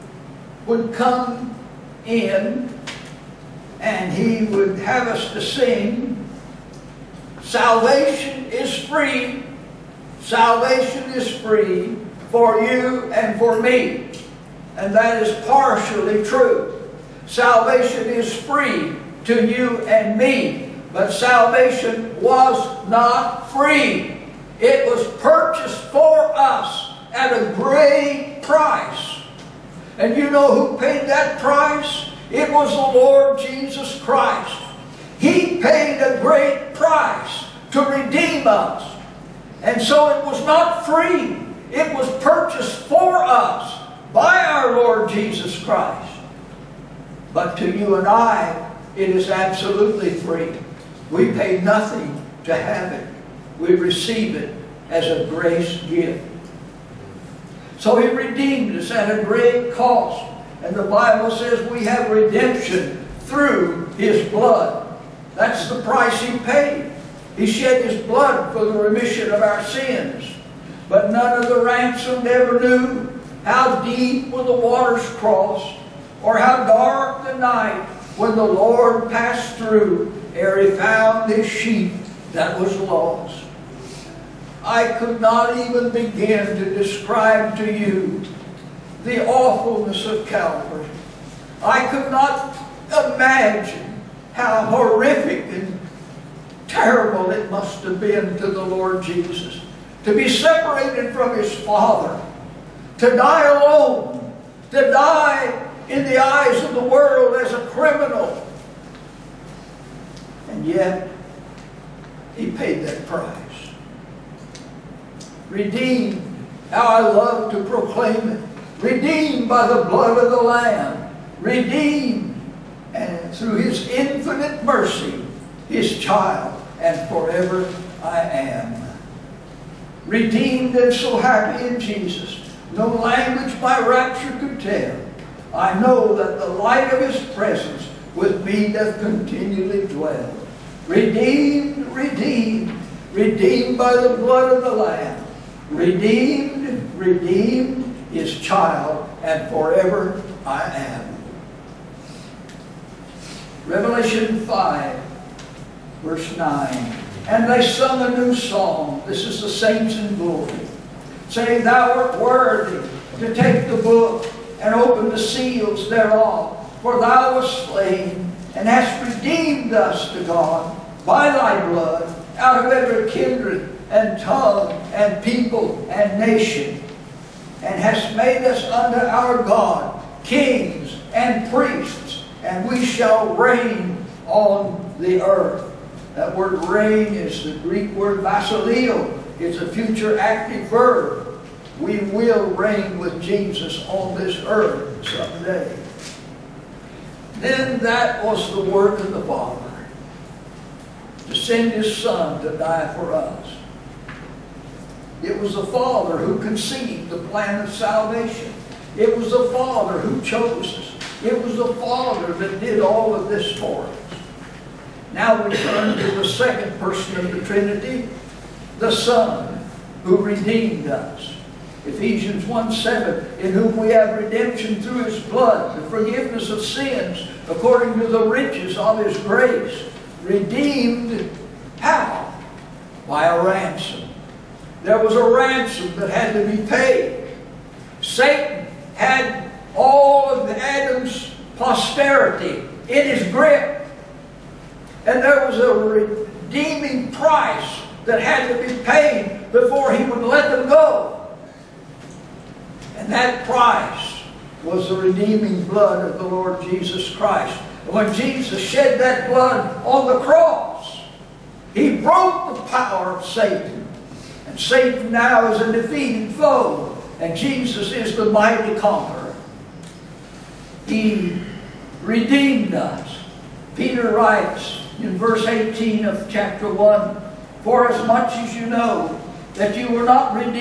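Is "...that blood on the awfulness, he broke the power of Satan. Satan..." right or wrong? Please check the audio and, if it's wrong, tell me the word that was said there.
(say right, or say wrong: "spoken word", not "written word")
wrong: "cross", not "awfulness".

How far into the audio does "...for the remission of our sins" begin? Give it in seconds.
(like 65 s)
68 s.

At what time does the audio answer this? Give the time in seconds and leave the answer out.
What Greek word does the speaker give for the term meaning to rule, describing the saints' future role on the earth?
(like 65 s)
188 s.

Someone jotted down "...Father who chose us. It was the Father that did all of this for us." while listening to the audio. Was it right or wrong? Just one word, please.
right.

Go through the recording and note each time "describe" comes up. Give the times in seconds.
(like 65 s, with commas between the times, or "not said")
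86 s.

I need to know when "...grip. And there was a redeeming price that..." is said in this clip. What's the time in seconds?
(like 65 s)
243 s.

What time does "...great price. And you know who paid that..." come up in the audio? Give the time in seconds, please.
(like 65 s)
27 s.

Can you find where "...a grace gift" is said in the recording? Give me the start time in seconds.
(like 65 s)
55 s.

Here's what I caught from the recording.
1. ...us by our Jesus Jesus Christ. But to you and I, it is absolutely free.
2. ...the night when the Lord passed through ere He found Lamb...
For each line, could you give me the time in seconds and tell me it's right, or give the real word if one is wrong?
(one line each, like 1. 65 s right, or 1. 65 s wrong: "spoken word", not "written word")
1. 43 s wrong: "Lord", not "Jesus"
2. 77 s wrong: "His", not "Lamb".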